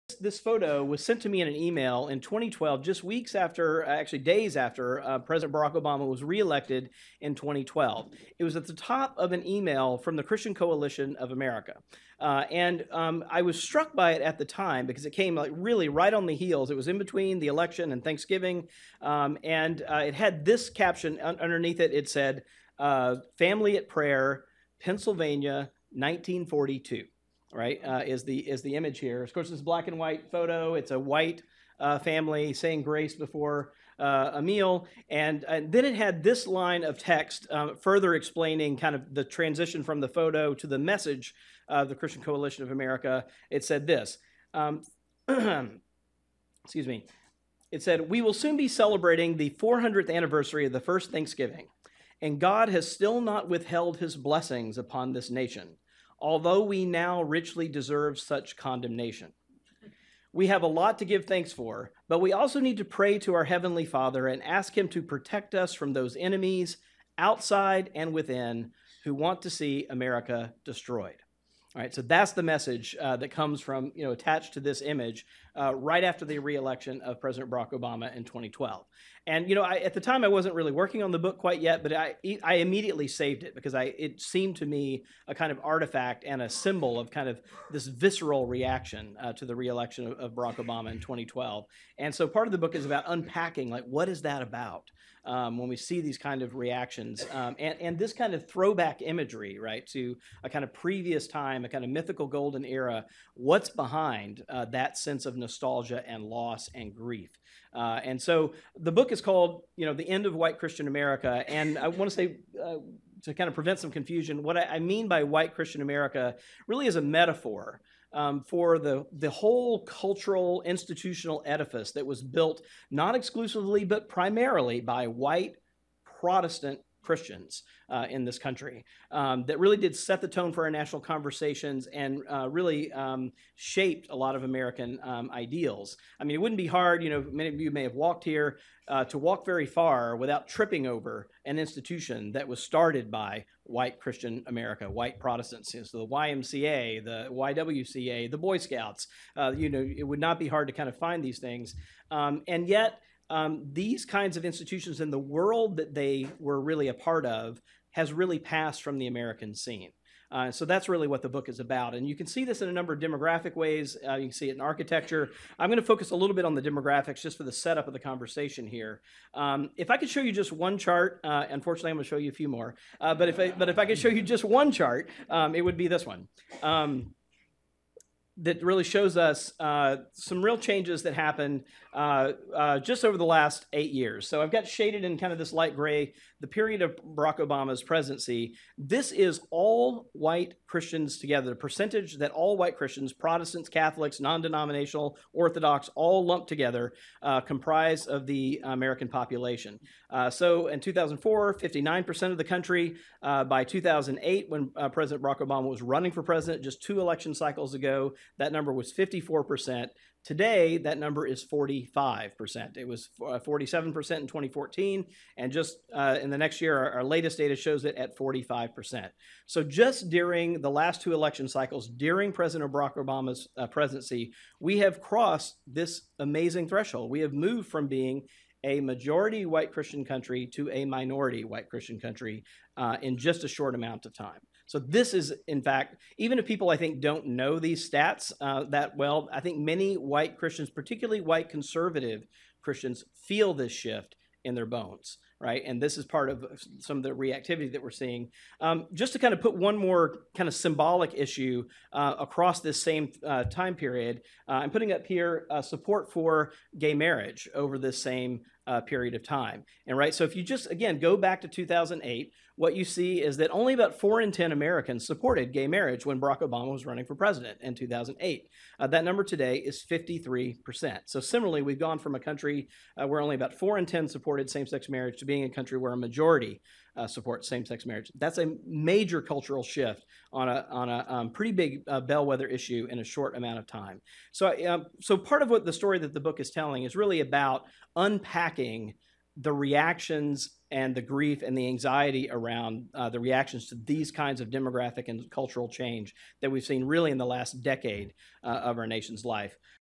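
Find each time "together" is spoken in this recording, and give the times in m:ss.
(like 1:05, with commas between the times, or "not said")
3:11, 3:16.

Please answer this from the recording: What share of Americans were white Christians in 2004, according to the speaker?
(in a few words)
59%.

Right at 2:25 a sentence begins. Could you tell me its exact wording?
So the YMCA, the YWCA, the Boy Scouts, uh, you know, it would not be hard to kind of find these things.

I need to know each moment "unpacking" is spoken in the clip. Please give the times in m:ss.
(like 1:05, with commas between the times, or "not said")
1:33, 4:47.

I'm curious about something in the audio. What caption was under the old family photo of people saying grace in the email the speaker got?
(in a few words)
Family at Prayer, Pennsylvania, 1942.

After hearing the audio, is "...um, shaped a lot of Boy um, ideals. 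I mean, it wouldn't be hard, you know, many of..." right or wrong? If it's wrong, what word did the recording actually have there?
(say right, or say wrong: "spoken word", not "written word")
wrong: "American", not "Boy".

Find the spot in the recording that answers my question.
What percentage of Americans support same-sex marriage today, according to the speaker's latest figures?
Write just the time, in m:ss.
4:29.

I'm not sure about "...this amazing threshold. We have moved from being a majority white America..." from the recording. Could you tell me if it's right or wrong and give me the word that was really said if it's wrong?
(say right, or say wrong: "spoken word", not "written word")
wrong: "Christian", not "America".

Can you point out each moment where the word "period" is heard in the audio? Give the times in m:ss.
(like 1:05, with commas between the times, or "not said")
3:06, 4:13, 4:18.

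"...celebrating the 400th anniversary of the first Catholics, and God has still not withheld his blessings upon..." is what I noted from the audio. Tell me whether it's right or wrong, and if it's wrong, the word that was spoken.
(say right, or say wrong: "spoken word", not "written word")
wrong: "Thanksgiving", not "Catholics".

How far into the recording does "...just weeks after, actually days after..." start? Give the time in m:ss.
0:02.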